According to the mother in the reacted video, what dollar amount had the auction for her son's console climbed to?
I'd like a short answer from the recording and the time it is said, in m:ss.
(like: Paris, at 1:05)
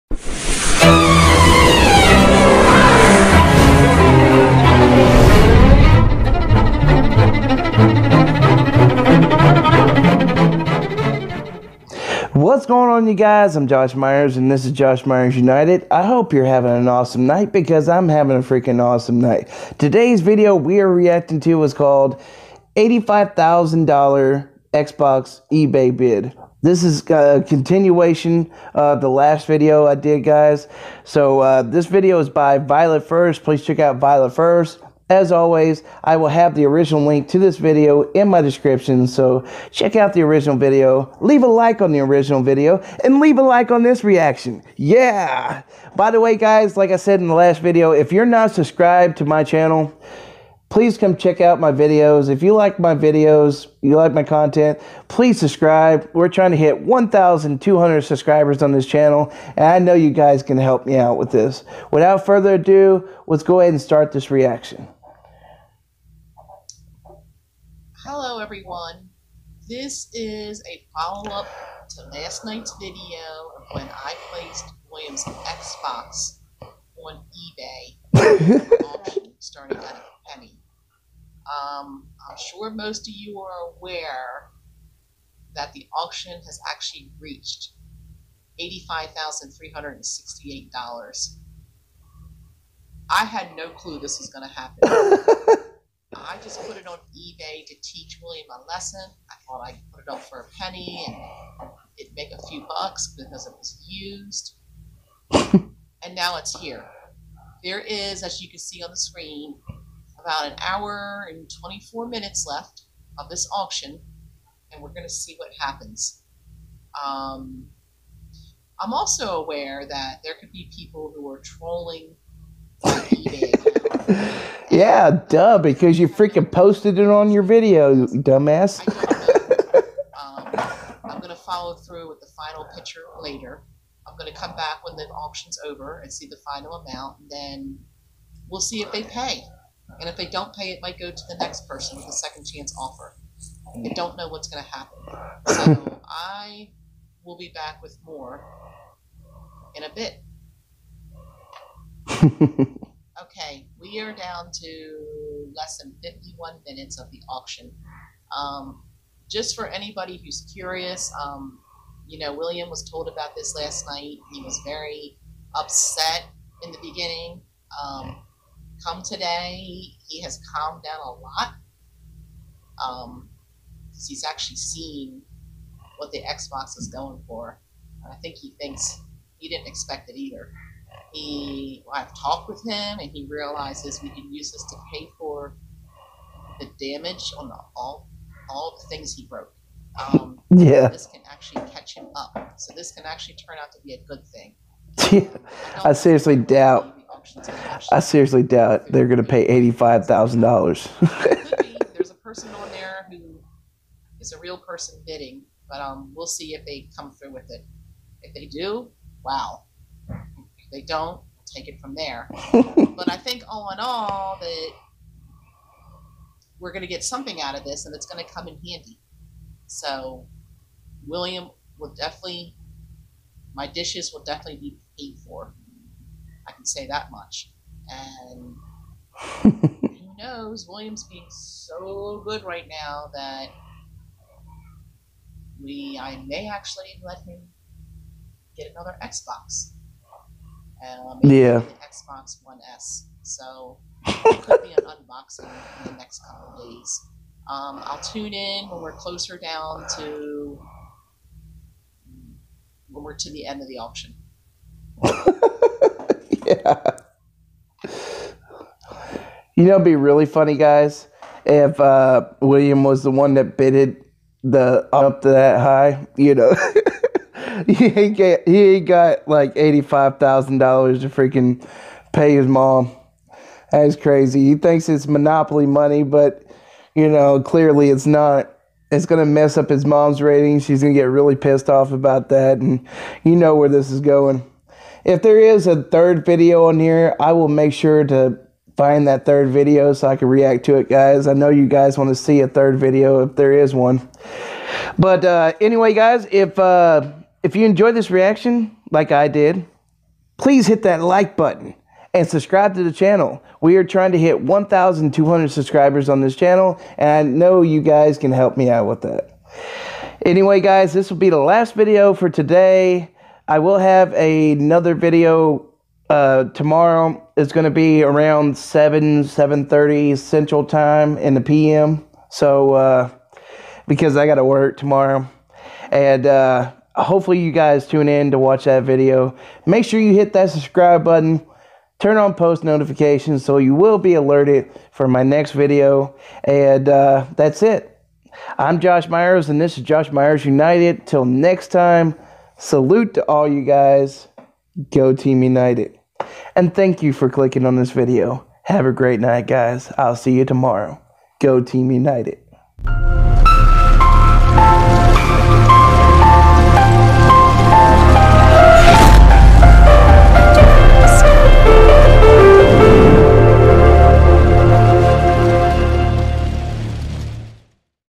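$85,368, at 1:28.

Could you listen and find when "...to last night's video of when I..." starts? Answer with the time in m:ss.
1:11.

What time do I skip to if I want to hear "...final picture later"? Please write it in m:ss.
2:12.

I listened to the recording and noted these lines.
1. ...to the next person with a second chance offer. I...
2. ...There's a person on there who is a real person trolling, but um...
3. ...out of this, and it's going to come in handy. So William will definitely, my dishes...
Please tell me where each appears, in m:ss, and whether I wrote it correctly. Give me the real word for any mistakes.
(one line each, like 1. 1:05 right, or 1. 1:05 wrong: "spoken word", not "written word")
1. 2:21 right
2. 3:21 wrong: "bidding", not "trolling"
3. 3:37 right.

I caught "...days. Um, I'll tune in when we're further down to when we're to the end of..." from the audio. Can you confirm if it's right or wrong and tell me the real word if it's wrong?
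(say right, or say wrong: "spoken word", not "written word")
wrong: "closer", not "further".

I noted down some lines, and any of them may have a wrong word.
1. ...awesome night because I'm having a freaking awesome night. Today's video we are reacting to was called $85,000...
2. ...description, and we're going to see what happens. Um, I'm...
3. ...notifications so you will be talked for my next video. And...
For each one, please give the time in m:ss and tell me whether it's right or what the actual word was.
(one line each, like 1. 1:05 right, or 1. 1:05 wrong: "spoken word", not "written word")
1. 0:16 right
2. 1:53 wrong: "auction", not "description"
3. 5:32 wrong: "alerted", not "talked".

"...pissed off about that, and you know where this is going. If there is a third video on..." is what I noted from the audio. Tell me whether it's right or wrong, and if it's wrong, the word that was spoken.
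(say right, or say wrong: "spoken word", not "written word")
right.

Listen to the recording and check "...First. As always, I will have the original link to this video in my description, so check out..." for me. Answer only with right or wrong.
right.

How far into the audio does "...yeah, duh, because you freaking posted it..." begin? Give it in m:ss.
2:04.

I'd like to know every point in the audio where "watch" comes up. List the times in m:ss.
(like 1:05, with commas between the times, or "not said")
5:28.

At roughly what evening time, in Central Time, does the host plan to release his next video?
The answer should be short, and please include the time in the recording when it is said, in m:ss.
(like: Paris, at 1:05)
7:30, at 5:19.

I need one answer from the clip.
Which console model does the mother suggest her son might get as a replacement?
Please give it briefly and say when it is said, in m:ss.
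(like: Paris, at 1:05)
Xbox One S, at 4:01.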